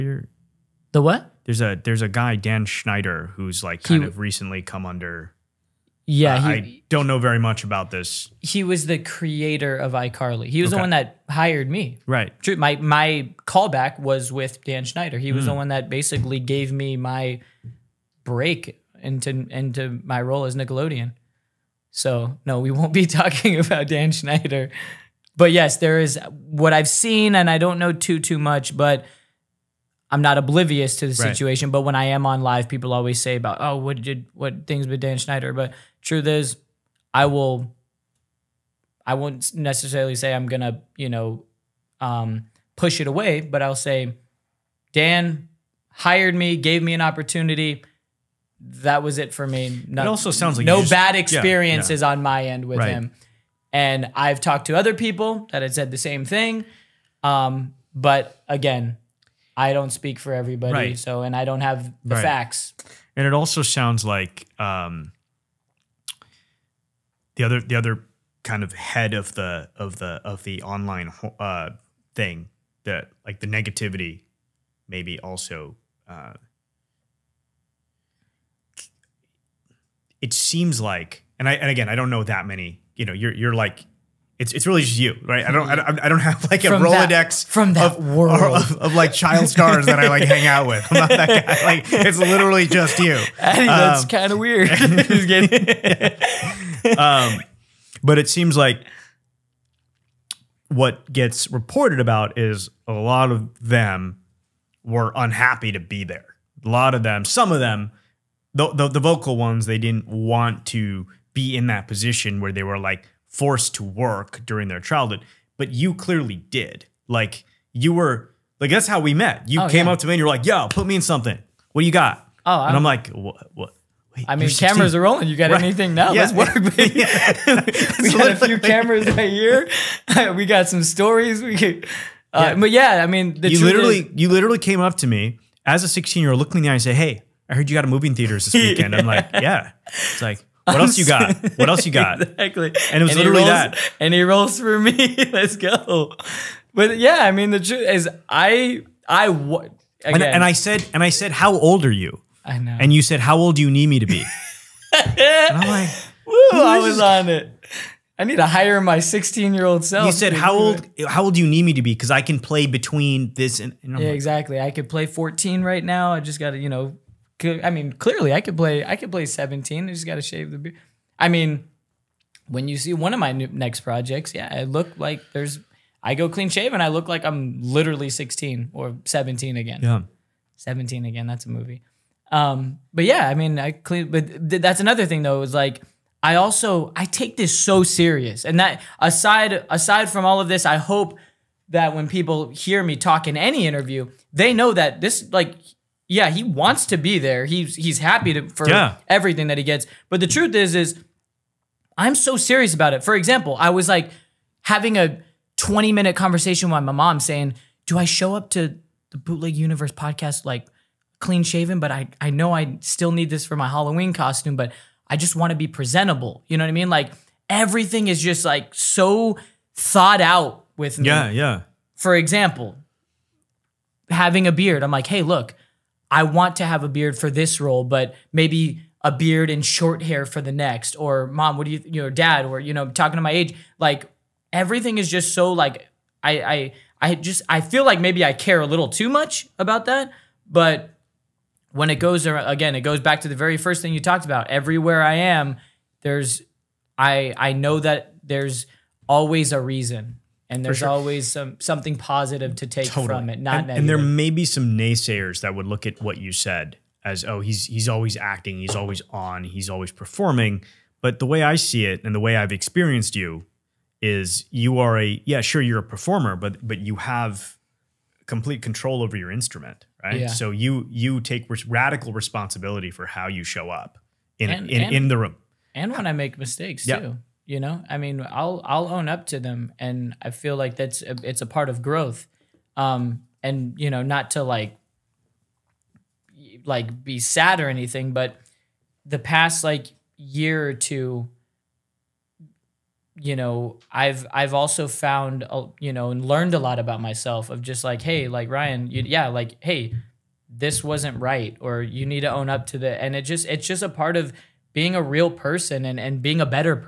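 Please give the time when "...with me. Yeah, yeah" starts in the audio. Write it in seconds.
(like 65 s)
220 s.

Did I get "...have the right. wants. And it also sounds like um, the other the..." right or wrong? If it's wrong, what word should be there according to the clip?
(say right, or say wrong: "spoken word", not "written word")
wrong: "facts", not "wants".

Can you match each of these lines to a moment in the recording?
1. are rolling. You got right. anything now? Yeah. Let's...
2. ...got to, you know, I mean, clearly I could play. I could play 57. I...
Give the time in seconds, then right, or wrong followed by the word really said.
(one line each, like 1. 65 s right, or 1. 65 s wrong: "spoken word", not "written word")
1. 124 s right
2. 166 s wrong: "17", not "57".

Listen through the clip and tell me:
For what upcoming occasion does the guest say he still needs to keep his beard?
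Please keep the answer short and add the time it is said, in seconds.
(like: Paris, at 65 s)
Halloween, at 213 s.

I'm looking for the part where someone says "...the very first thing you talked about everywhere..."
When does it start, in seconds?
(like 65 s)
243 s.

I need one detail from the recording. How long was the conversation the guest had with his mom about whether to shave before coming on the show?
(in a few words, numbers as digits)
20 minutes.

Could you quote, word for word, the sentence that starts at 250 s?
always some something positive to take totally.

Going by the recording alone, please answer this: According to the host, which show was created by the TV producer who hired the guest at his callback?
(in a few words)
iCarly.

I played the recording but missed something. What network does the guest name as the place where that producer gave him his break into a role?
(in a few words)
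Nickelodeon.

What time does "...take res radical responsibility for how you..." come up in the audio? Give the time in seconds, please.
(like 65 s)
271 s.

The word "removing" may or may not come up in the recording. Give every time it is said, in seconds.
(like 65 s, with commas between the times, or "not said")
not said.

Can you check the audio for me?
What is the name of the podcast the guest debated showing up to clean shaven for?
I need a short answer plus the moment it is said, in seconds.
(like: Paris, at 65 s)
Bootleg Universe, at 209 s.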